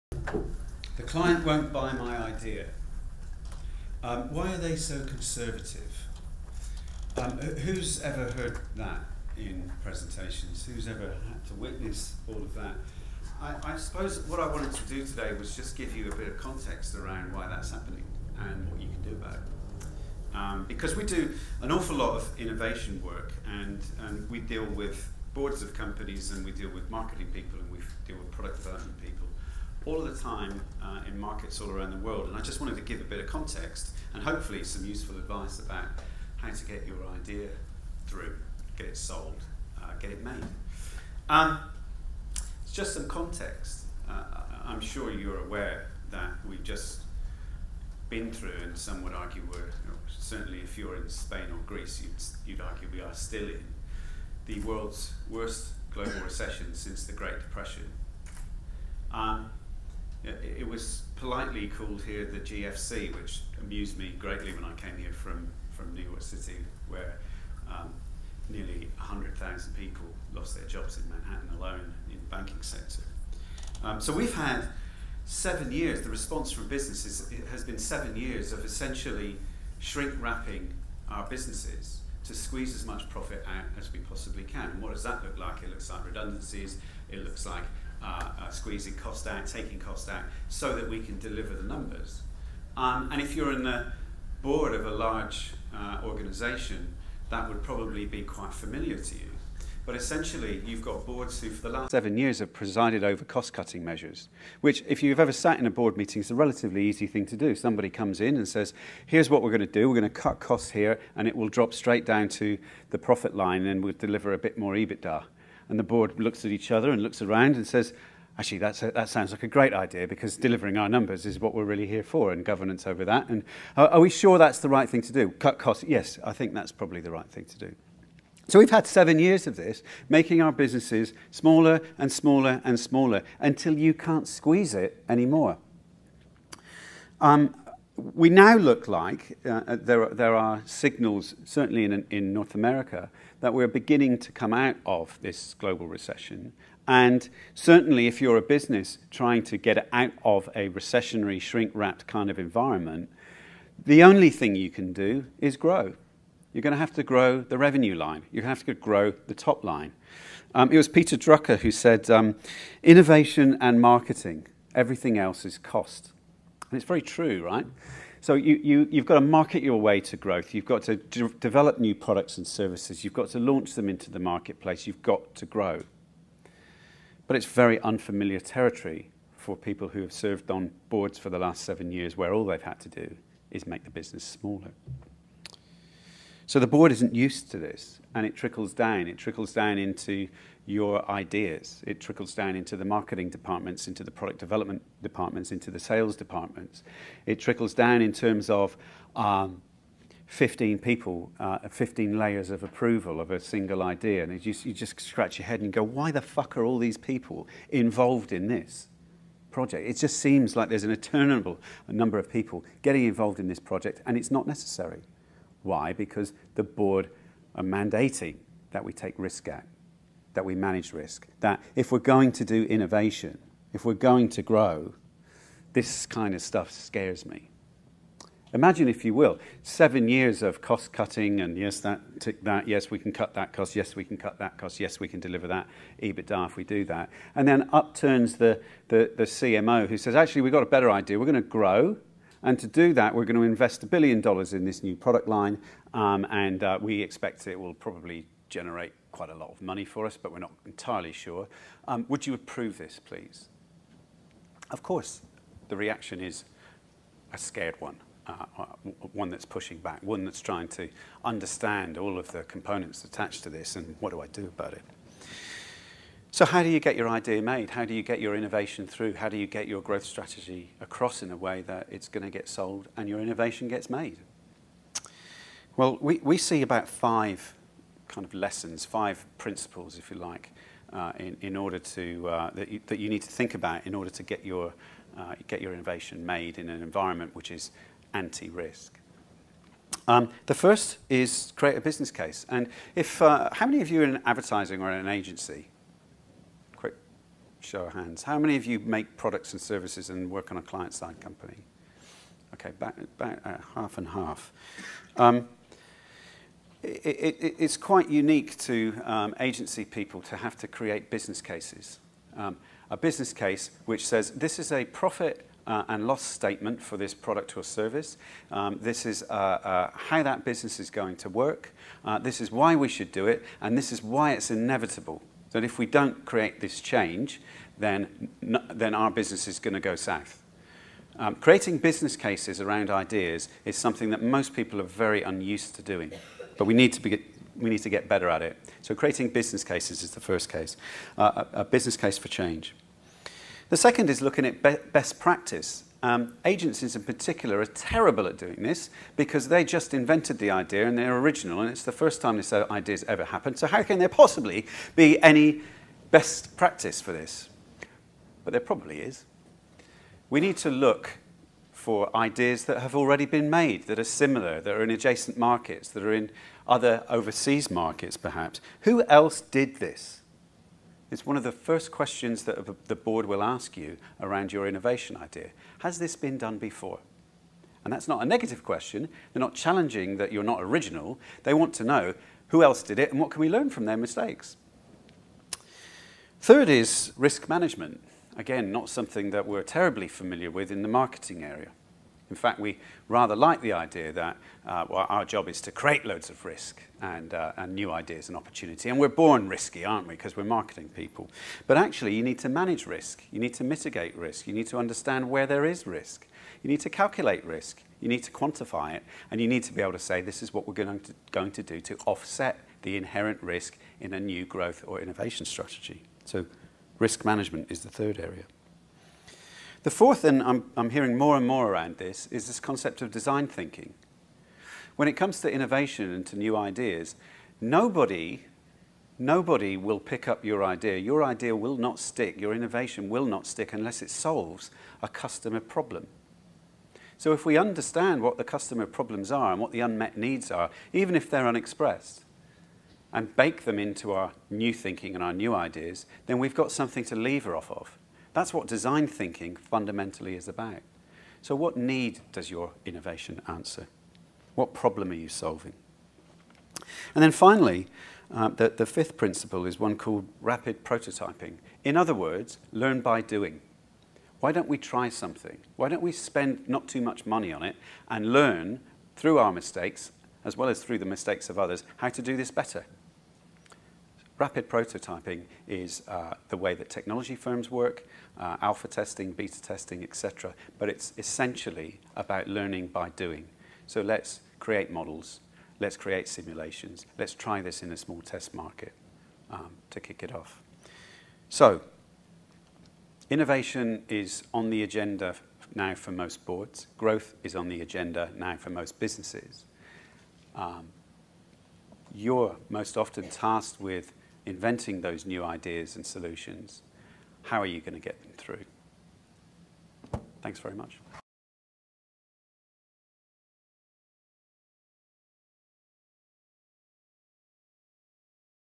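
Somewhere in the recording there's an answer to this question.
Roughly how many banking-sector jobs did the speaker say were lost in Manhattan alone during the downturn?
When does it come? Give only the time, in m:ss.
1:08.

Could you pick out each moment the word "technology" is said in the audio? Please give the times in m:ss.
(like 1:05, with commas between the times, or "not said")
7:56.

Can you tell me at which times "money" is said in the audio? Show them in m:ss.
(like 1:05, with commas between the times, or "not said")
4:09, 7:47.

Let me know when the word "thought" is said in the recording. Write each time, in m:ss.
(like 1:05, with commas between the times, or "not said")
not said.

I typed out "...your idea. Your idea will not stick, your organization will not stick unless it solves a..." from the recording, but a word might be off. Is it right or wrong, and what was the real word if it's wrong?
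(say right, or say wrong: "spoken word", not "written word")
wrong: "innovation", not "organization".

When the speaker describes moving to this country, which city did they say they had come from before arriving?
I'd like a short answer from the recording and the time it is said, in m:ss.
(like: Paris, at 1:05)
New York City, at 1:05.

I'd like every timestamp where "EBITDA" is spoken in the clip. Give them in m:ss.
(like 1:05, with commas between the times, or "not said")
1:54, 3:56.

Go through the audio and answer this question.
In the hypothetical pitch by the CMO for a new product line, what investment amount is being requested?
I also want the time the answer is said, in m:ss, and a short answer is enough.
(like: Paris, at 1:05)
a billion dollars, at 4:03.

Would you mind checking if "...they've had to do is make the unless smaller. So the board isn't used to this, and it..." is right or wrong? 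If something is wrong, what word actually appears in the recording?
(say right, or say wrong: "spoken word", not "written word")
wrong: "business", not "unless".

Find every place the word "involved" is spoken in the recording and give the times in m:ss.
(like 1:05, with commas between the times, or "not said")
3:27, 3:33.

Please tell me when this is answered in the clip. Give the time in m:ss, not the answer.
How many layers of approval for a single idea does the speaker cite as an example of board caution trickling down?
3:21.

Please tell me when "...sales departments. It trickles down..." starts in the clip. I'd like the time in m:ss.
3:15.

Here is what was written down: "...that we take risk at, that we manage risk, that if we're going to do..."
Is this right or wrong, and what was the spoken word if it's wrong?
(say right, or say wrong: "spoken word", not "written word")
right.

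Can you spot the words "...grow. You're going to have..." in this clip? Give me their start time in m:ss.
2:35.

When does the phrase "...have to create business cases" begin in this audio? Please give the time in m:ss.
5:10.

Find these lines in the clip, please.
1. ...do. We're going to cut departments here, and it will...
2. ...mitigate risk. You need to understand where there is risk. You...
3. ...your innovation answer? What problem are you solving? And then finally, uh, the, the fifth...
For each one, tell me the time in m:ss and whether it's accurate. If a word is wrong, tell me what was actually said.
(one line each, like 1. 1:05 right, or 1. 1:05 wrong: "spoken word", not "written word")
1. 1:49 wrong: "costs", not "departments"
2. 6:43 right
3. 7:32 right.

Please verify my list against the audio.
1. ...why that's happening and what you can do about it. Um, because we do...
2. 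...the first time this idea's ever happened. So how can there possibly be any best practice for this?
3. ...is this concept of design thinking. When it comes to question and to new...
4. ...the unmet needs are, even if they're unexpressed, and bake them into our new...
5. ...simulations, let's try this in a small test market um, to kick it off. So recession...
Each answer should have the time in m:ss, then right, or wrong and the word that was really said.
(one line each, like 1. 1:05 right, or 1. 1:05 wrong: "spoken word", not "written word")
1. 0:17 right
2. 5:51 right
3. 7:02 wrong: "innovation", not "question"
4. 7:19 right
5. 8:06 wrong: "innovation", not "recession".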